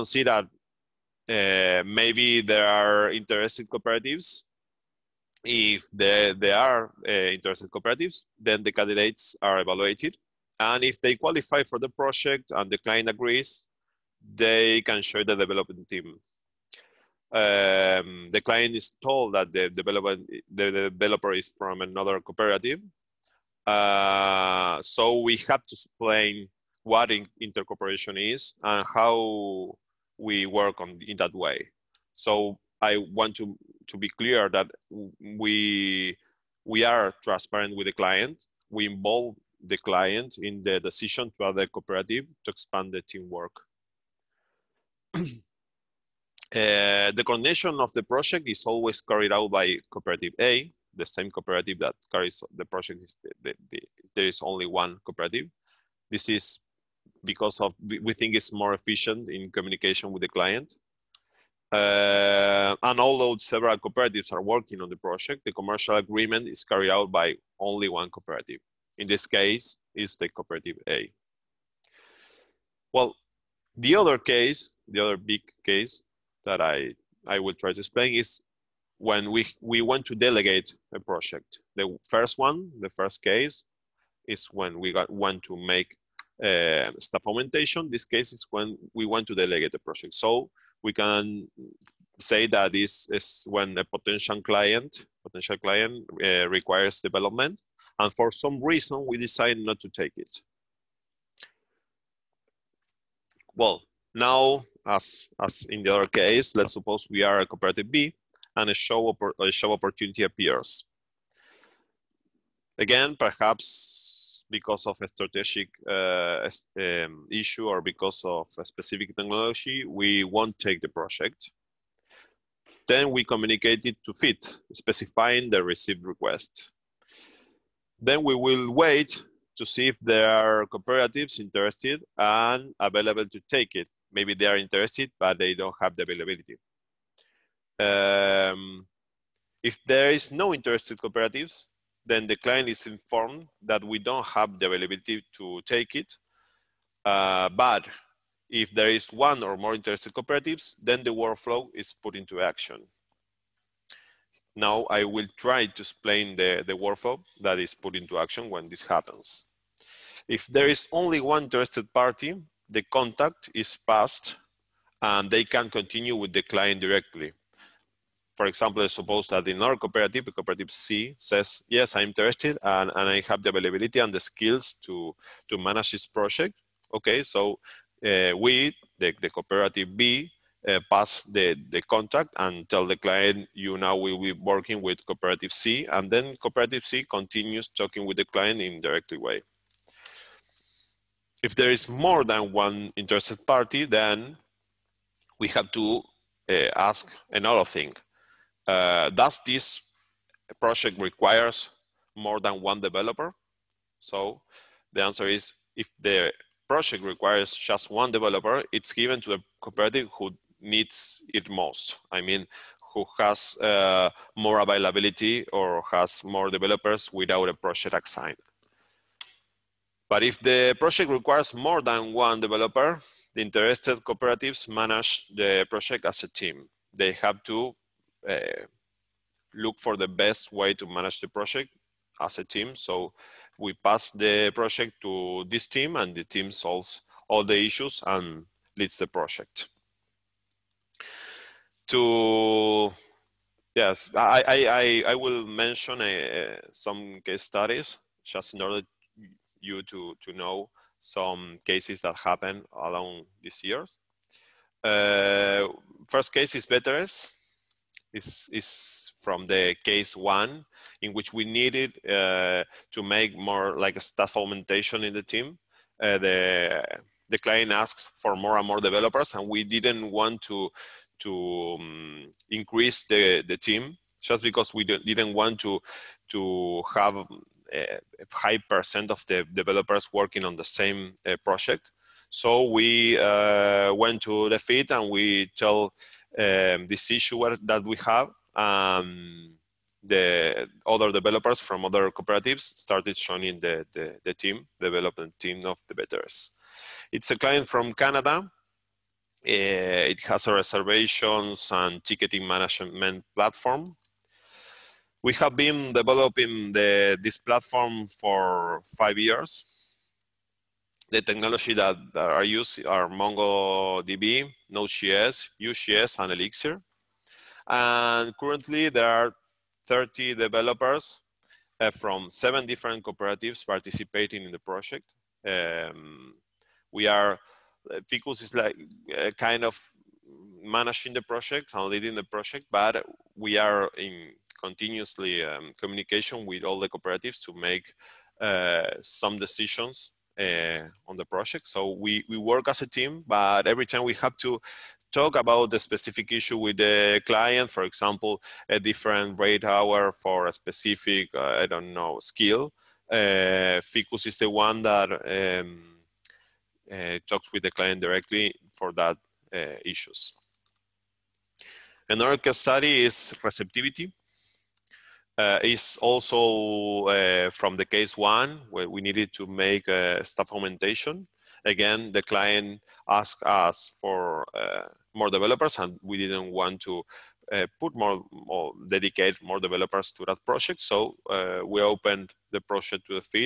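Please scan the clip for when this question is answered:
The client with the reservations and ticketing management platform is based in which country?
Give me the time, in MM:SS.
04:57.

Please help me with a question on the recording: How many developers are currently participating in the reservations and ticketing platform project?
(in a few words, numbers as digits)
30.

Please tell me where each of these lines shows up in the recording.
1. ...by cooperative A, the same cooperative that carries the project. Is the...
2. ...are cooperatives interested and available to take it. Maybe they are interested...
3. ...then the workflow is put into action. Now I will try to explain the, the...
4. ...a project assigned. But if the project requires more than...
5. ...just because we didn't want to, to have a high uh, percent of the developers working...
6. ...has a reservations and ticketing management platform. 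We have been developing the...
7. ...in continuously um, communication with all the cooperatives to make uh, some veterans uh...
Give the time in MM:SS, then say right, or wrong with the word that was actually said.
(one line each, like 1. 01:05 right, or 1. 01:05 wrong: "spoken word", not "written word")
1. 00:49 right
2. 02:10 right
3. 02:30 right
4. 03:37 right
5. 04:34 right
6. 05:00 right
7. 05:33 wrong: "decisions", not "veterans".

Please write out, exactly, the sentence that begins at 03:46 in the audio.
They have to uh, look for the best way to manage the project as a team.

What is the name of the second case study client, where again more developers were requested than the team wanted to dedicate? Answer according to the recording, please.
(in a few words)
Receptiviti.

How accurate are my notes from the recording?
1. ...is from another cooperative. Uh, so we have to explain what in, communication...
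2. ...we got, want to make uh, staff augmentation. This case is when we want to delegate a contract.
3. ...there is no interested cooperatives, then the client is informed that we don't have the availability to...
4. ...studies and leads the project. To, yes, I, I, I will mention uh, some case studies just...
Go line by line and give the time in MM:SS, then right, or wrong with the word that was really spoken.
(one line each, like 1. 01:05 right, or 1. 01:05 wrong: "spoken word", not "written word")
1. 00:21 wrong: "intercooperation", not "communication"
2. 01:24 wrong: "project", not "contract"
3. 02:19 right
4. 03:57 wrong: "issues", not "studies".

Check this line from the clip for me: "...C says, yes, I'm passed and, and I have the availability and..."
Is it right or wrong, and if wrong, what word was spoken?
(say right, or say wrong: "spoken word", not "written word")
wrong: "interested", not "passed".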